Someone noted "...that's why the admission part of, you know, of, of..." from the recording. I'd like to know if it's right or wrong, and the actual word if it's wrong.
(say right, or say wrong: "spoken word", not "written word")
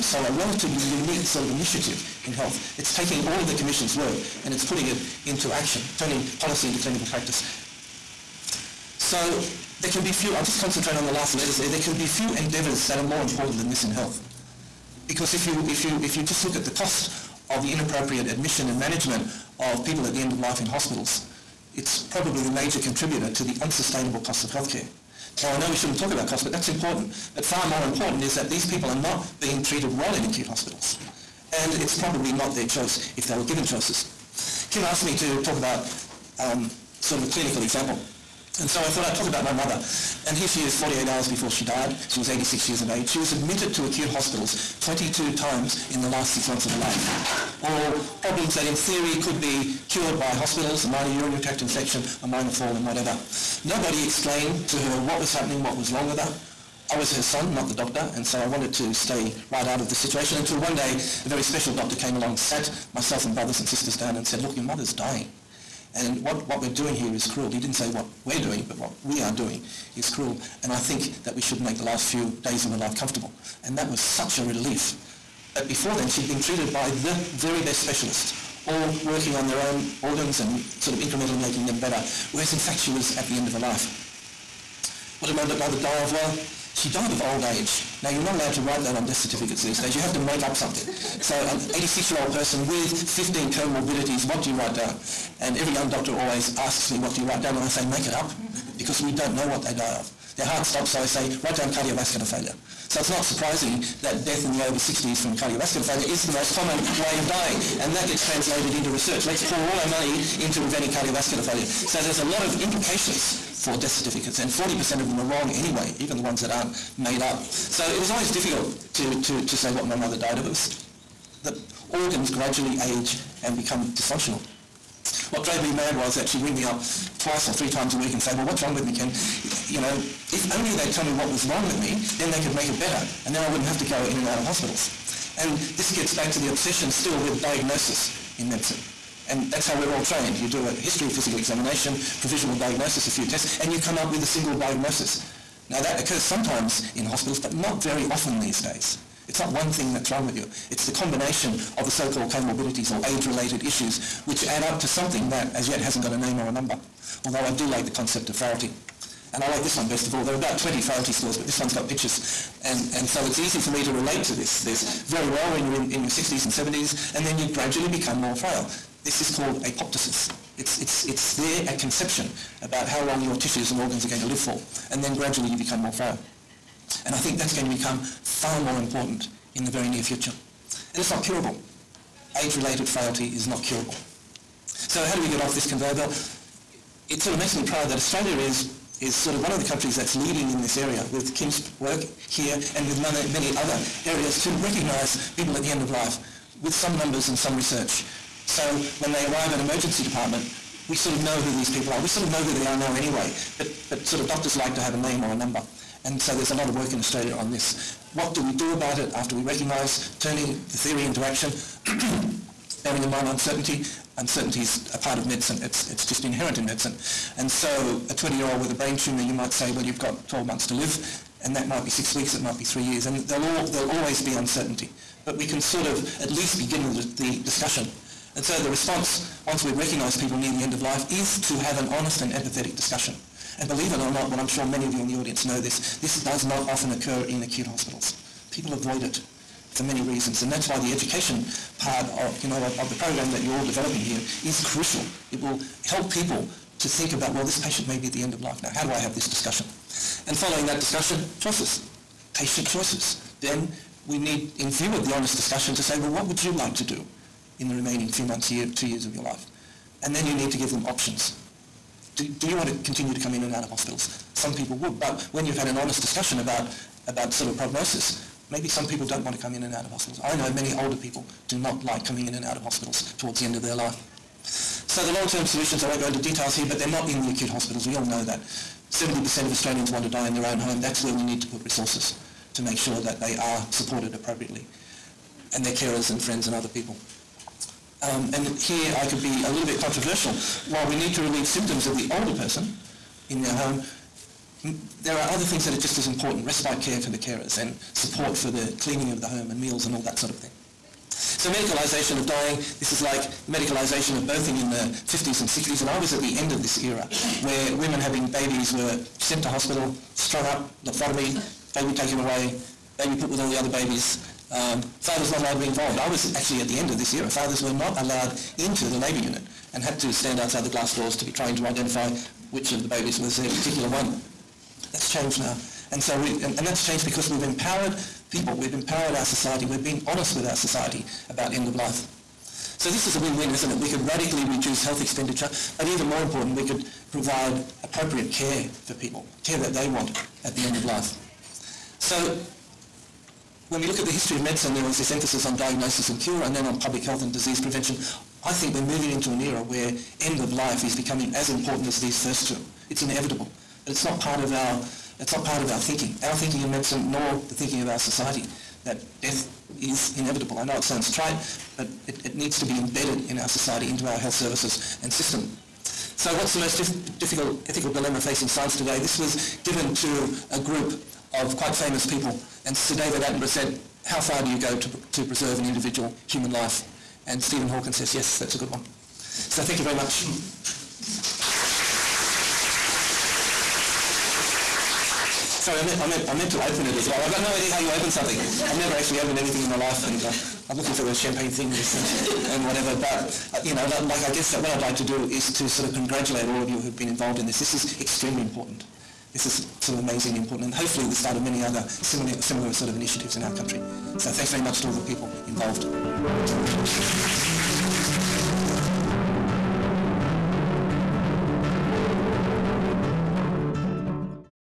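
wrong: "education", not "admission".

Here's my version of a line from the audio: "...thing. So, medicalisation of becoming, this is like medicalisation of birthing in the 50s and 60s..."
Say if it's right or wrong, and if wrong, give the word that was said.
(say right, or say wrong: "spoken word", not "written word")
wrong: "dying", not "becoming".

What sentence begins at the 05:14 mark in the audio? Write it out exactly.
Um, fathers not allowed to be involved.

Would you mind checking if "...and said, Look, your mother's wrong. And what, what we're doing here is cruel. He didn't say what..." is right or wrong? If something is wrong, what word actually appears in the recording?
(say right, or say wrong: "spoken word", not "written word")
wrong: "dying", not "wrong".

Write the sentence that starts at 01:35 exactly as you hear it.
And every young doctor always asks me, What do you write down?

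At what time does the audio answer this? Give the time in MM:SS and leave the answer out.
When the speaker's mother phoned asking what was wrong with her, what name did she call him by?
02:08.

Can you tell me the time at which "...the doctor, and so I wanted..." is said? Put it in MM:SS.
00:57.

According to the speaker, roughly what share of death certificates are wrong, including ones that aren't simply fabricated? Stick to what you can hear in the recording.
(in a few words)
40%.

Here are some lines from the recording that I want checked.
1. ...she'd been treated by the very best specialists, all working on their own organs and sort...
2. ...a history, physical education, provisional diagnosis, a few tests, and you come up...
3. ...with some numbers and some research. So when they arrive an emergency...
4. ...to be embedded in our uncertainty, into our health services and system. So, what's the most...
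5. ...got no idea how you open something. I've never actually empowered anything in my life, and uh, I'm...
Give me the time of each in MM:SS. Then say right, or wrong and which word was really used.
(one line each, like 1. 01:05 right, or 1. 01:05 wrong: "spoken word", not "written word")
1. 01:16 right
2. 02:20 wrong: "examination", not "education"
3. 03:16 right
4. 06:02 wrong: "society", not "uncertainty"
5. 06:27 wrong: "opened", not "empowered".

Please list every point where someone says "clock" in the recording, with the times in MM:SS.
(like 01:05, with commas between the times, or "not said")
not said.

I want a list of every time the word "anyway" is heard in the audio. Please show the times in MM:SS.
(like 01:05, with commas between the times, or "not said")
01:55, 03:22.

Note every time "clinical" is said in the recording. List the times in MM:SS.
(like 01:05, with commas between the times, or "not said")
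00:06, 00:37.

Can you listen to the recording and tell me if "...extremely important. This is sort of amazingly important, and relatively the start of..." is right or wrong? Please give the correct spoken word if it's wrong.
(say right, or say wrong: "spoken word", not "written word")
wrong: "hopefully", not "relatively".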